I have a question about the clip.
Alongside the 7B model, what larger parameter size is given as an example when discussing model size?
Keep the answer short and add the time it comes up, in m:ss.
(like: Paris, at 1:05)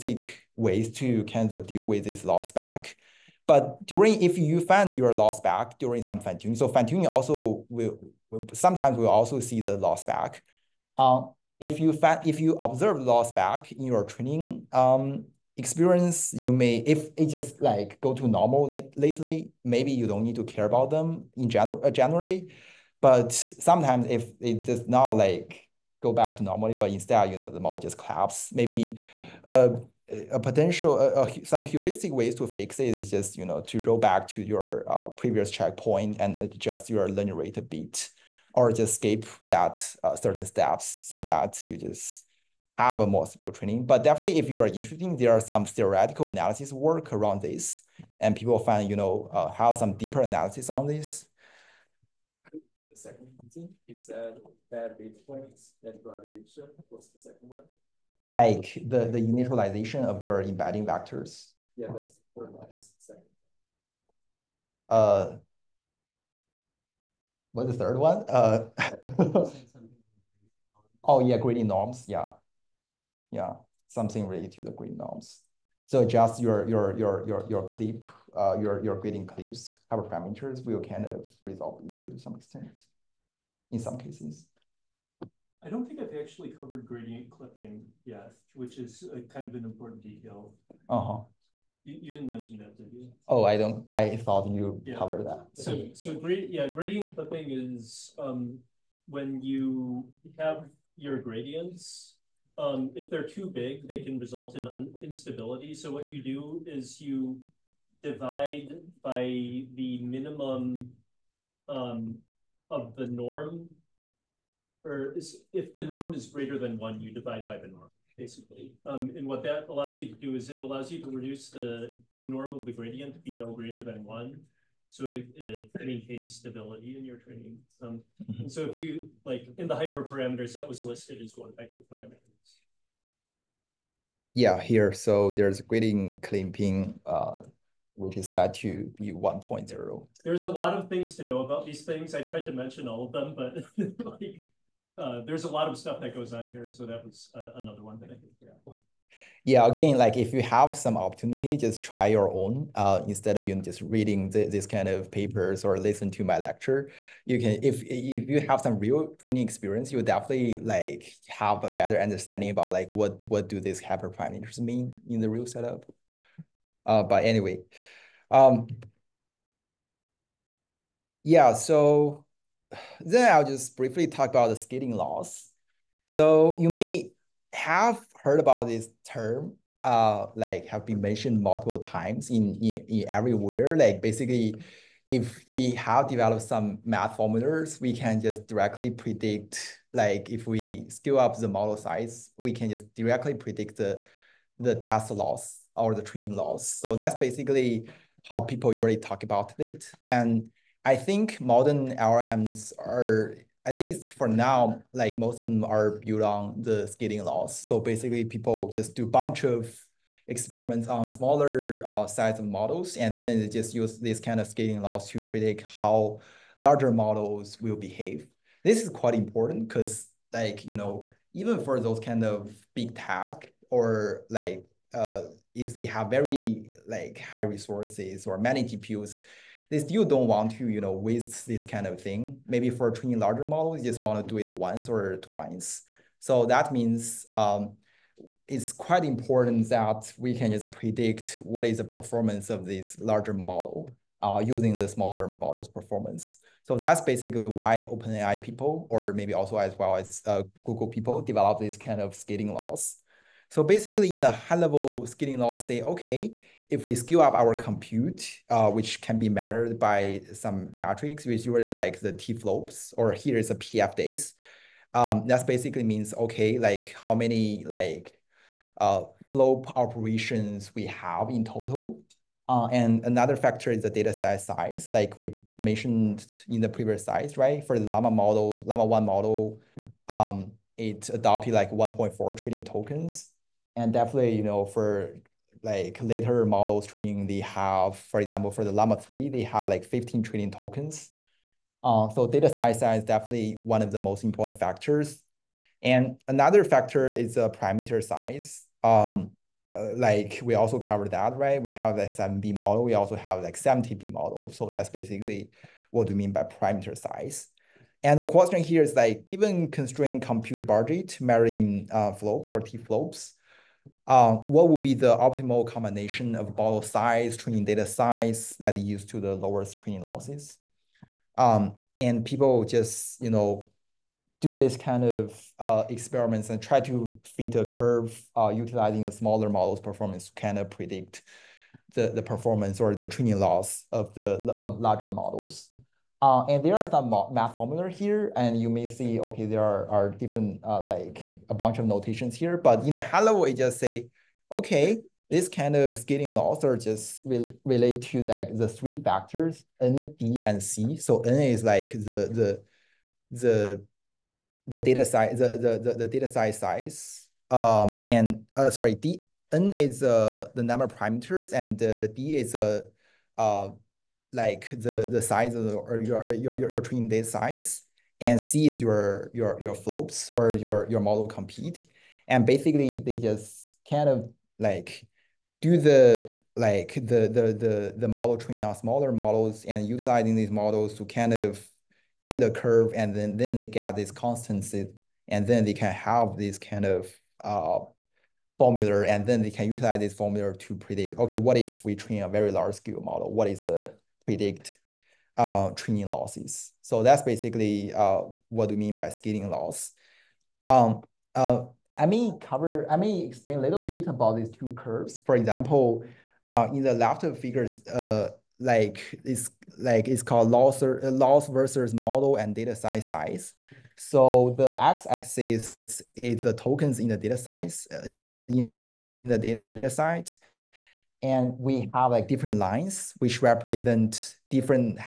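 70B, at 5:03.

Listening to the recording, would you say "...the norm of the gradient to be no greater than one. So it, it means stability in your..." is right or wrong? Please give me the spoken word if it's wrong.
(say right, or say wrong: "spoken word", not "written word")
wrong: "maintains", not "means".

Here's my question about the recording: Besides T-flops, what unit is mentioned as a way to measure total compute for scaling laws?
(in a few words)
PF days.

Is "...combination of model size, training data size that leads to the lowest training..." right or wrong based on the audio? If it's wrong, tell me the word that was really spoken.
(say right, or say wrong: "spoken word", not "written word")
right.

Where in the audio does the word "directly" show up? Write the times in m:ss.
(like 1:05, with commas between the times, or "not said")
3:08, 3:12.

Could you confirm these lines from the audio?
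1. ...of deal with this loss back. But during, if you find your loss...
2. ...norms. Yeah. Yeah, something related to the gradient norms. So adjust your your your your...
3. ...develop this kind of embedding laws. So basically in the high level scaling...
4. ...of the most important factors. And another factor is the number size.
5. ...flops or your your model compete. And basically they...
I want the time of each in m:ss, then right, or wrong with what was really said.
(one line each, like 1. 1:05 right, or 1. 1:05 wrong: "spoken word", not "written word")
1. 0:01 right
2. 1:11 right
3. 4:11 wrong: "scaling", not "embedding"
4. 4:53 wrong: "parameter", not "number"
5. 6:09 right.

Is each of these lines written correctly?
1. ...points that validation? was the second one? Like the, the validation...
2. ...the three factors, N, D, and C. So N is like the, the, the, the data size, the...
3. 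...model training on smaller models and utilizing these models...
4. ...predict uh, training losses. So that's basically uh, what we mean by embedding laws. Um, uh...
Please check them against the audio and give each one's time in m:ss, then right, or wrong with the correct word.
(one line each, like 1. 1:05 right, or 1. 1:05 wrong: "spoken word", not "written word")
1. 0:55 wrong: "initialization", not "validation"
2. 5:48 right
3. 6:18 right
4. 6:34 wrong: "scaling", not "embedding".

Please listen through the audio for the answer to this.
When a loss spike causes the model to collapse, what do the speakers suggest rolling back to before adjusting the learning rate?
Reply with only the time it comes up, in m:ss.
0:35.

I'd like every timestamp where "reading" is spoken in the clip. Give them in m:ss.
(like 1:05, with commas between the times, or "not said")
2:33.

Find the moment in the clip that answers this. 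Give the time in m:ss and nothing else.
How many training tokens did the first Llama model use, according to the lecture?
4:41.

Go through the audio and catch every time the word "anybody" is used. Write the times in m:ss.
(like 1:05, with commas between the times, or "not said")
not said.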